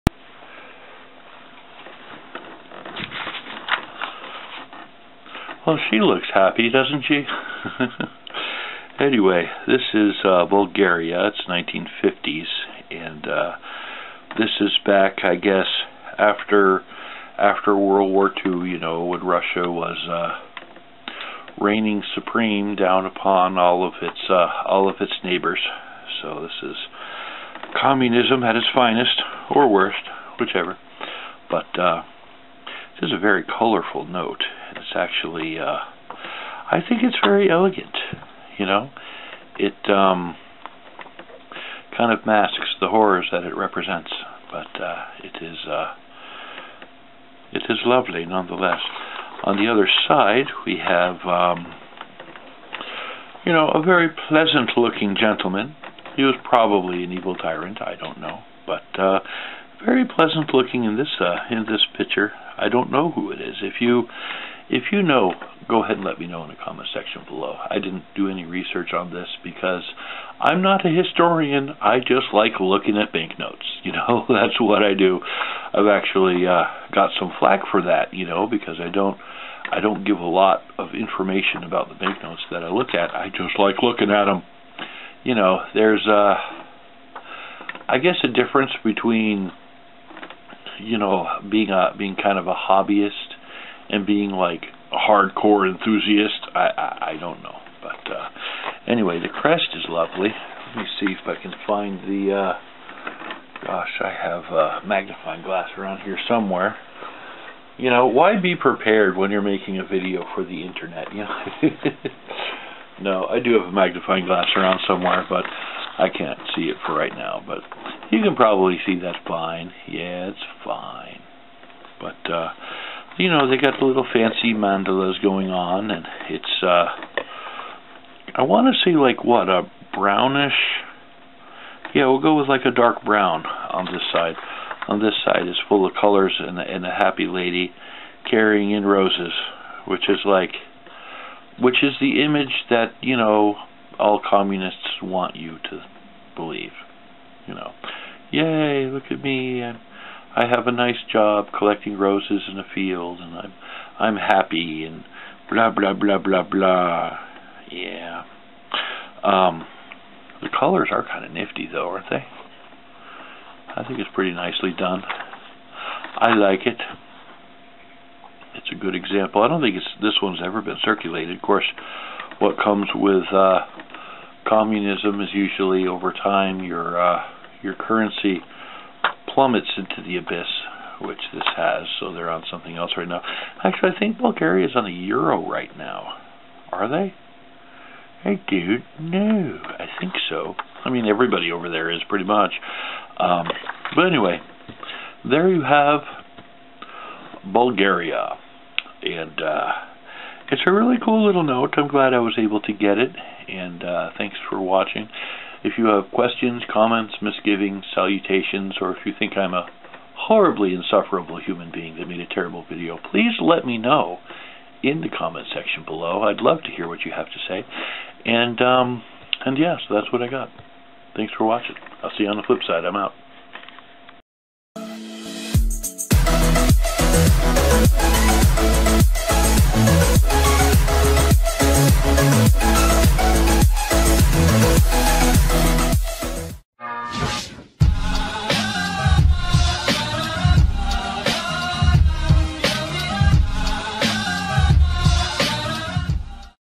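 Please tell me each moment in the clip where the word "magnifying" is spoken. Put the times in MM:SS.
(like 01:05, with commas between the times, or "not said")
01:44, 01:53.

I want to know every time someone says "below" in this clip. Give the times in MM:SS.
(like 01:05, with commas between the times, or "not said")
01:07, 03:35.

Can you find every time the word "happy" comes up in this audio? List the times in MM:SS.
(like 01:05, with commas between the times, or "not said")
00:06, 02:16, 02:34.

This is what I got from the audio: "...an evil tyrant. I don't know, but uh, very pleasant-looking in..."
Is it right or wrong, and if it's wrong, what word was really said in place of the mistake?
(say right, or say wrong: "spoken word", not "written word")
right.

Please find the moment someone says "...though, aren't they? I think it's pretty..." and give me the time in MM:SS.
02:41.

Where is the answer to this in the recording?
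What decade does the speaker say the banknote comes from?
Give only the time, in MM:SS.
00:11.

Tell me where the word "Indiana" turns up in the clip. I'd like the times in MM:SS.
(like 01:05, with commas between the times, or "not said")
not said.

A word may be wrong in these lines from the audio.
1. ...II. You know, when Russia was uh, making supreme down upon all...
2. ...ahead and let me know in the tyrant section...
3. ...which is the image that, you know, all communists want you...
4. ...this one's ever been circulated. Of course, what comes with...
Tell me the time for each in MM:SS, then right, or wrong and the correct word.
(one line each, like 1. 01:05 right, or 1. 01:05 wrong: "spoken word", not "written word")
1. 00:18 wrong: "reigning", not "making"
2. 01:05 wrong: "comment", not "tyrant"
3. 02:21 right
4. 02:50 right.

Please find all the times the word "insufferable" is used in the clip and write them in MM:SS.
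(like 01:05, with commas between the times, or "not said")
03:30.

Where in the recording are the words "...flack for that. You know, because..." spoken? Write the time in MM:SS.
01:17.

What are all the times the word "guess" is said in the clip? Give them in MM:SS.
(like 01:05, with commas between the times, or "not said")
00:15, 01:27.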